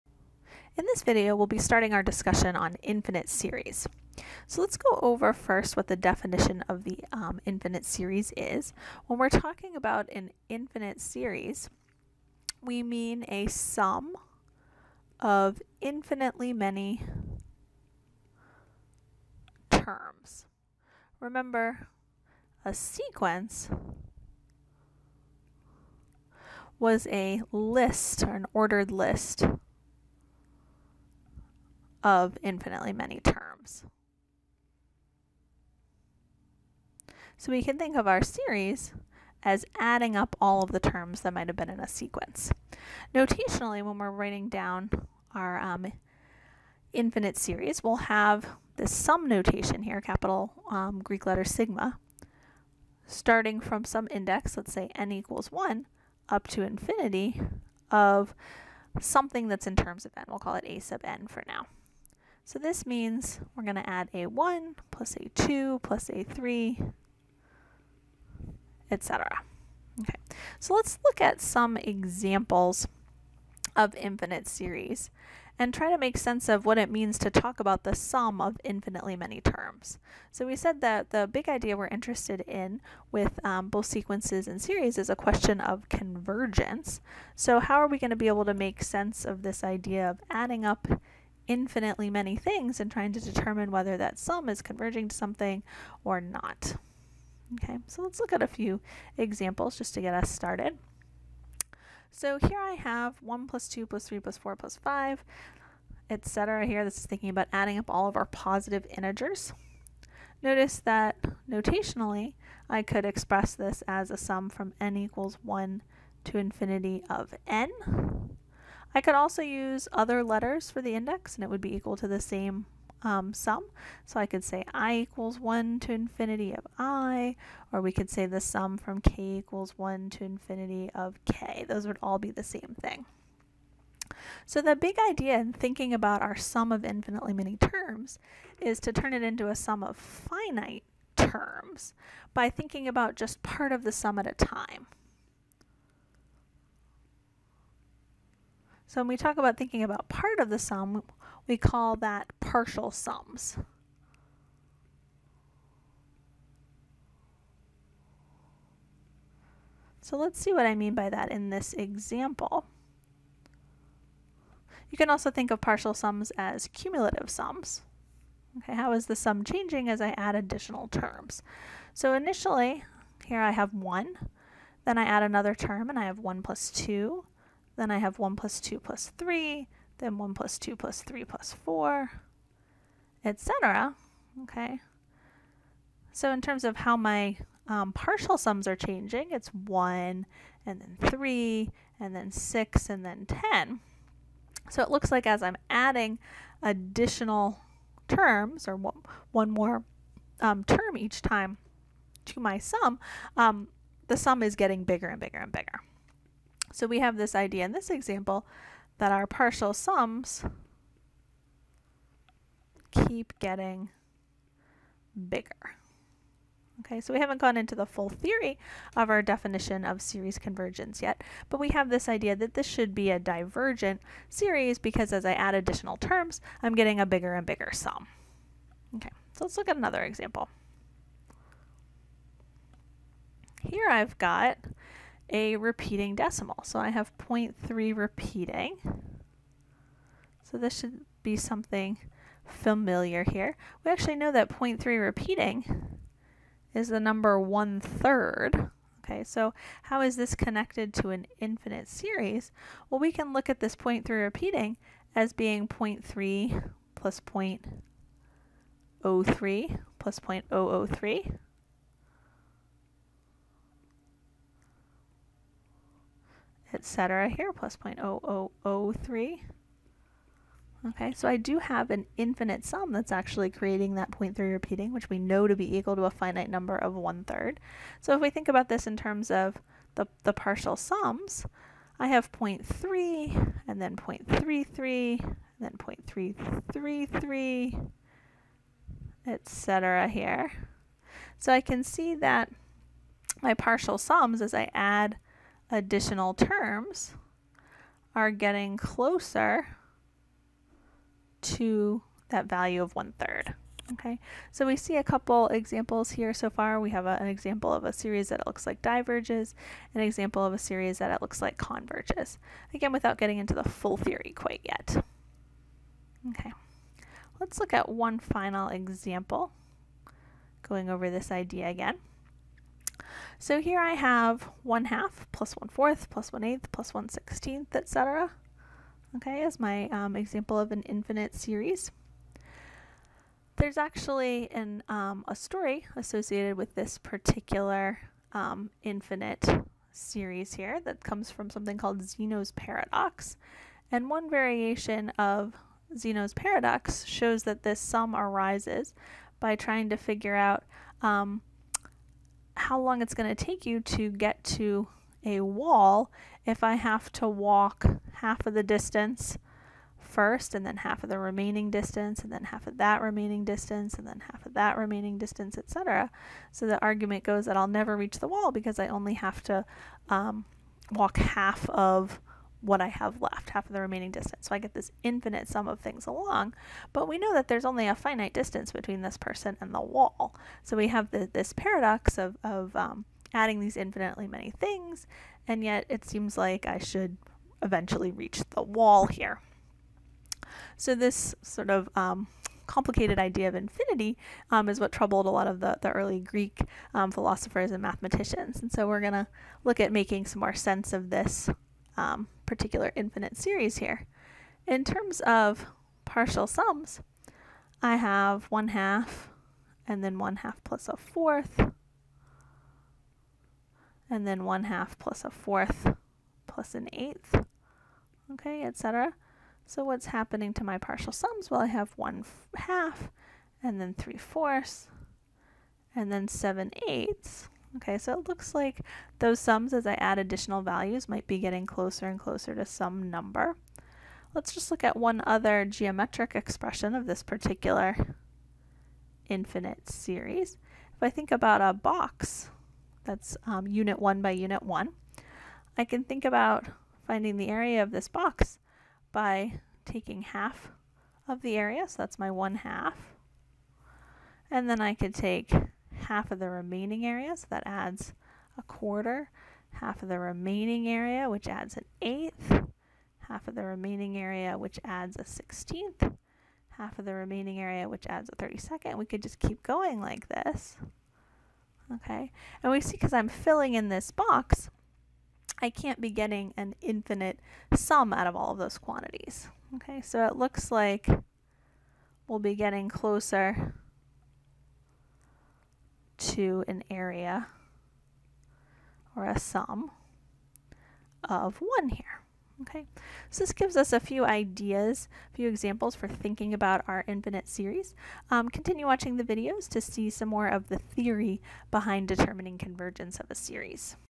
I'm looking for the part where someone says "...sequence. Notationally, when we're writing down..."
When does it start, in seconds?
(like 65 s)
41 s.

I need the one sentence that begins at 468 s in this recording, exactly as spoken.
We could just keep going like this.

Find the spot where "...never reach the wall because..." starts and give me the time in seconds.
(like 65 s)
367 s.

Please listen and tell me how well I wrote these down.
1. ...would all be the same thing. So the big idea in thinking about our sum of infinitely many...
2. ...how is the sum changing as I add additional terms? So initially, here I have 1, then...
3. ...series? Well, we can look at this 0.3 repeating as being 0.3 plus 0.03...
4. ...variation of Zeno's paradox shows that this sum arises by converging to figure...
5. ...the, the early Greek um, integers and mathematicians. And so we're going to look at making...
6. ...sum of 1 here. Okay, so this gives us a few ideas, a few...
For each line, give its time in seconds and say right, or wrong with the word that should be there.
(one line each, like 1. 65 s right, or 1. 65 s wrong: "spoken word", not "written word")
1. 131 s right
2. 168 s right
3. 251 s right
4. 344 s wrong: "trying", not "converging"
5. 395 s wrong: "philosophers", not "integers"
6. 489 s right.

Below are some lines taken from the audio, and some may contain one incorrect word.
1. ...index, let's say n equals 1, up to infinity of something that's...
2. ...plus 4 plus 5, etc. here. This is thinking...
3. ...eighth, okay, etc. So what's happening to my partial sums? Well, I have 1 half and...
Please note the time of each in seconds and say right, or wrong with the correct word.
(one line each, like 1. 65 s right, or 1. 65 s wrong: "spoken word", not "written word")
1. 54 s right
2. 104 s right
3. 416 s right.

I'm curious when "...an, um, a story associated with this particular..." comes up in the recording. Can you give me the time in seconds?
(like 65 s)
334 s.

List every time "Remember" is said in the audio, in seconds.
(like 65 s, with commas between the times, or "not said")
21 s.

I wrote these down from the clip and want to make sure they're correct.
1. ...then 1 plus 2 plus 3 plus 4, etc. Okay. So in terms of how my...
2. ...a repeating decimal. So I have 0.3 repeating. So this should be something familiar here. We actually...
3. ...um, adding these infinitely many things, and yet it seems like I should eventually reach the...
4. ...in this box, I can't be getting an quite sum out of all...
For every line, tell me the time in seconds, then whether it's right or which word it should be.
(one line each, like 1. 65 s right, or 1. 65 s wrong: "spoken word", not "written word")
1. 179 s right
2. 235 s right
3. 382 s right
4. 473 s wrong: "infinite", not "quite".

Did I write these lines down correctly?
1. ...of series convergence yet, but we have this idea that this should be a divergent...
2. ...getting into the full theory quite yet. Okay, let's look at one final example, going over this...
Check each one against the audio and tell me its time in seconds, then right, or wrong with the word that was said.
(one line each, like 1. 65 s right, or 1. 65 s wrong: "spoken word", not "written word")
1. 219 s right
2. 313 s right.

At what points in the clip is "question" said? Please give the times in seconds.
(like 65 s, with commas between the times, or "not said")
85 s.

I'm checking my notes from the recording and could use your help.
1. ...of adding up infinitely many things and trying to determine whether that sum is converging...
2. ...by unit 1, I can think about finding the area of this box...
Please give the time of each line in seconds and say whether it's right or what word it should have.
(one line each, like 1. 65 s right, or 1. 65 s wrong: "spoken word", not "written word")
1. 90 s right
2. 444 s right.